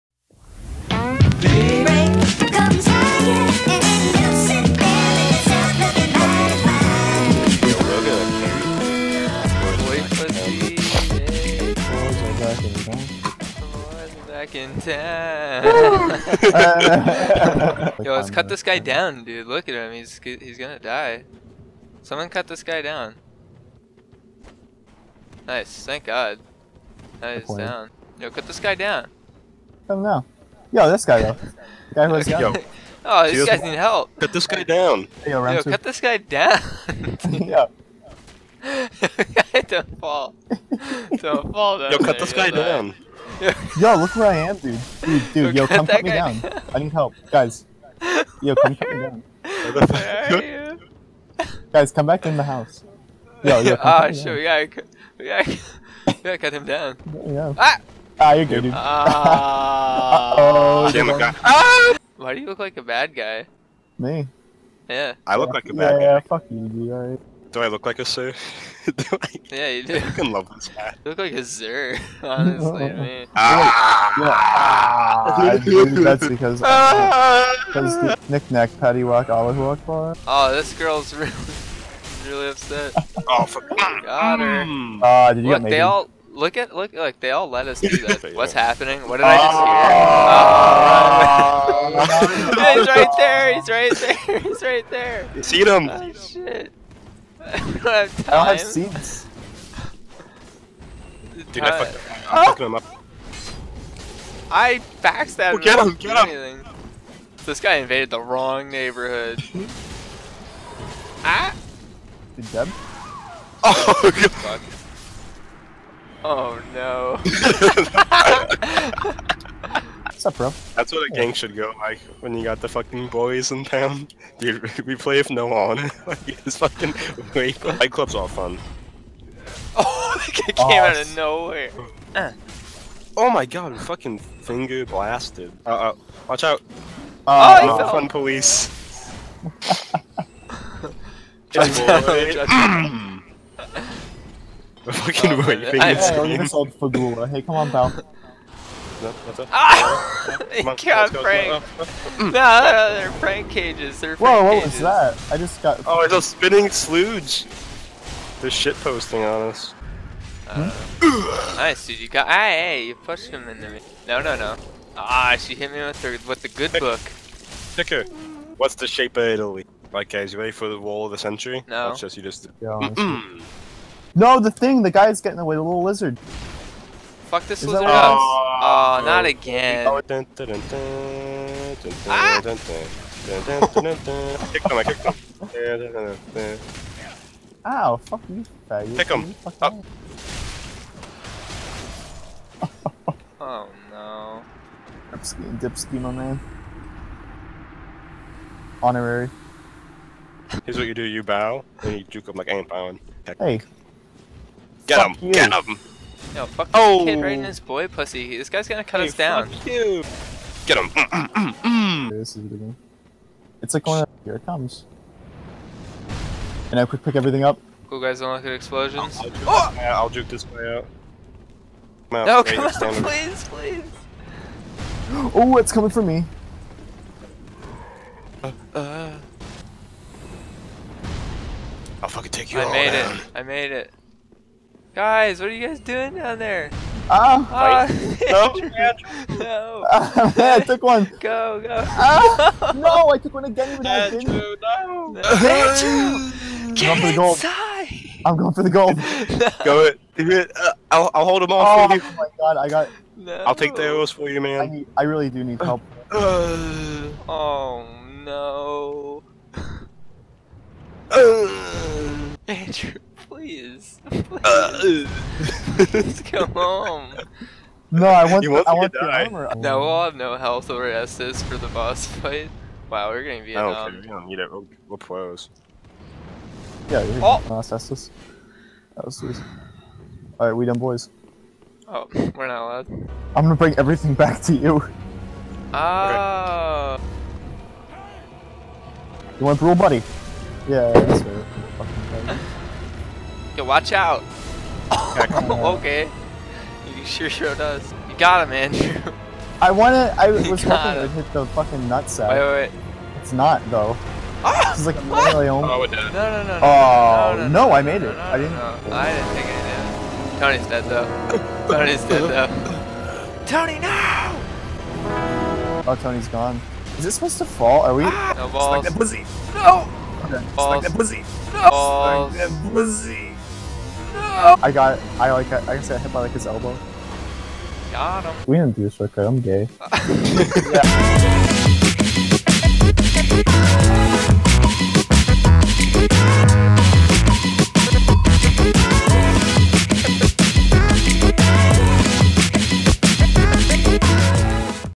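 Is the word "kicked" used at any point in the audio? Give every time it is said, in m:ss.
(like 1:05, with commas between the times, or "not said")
3:00, 3:04.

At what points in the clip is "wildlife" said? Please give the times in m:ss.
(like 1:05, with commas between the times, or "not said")
not said.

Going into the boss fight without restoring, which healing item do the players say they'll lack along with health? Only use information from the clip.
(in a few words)
Estus.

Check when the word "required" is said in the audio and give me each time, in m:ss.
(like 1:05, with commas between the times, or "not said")
not said.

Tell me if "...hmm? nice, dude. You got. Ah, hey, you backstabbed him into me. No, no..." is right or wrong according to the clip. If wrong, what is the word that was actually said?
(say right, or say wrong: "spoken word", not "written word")
wrong: "pushed", not "backstabbed".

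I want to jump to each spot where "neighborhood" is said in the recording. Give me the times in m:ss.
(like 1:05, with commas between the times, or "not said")
1:48.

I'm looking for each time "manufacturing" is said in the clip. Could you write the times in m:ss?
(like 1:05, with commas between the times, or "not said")
not said.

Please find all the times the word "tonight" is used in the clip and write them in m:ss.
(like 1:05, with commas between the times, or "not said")
not said.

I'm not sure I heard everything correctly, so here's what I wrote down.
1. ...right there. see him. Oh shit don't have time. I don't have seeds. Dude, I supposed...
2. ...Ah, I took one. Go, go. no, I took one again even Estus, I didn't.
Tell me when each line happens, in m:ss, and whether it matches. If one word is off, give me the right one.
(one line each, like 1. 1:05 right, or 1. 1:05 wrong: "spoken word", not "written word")
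1. 1:34 wrong: "fucked", not "supposed"
2. 3:59 wrong: "Andrew", not "Estus".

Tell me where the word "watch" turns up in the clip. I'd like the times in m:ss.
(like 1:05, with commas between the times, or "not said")
2:16, 4:53.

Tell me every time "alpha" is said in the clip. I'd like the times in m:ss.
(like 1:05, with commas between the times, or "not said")
not said.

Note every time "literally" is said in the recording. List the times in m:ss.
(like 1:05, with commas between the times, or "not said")
5:05.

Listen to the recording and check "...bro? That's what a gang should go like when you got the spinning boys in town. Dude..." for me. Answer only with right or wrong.
wrong.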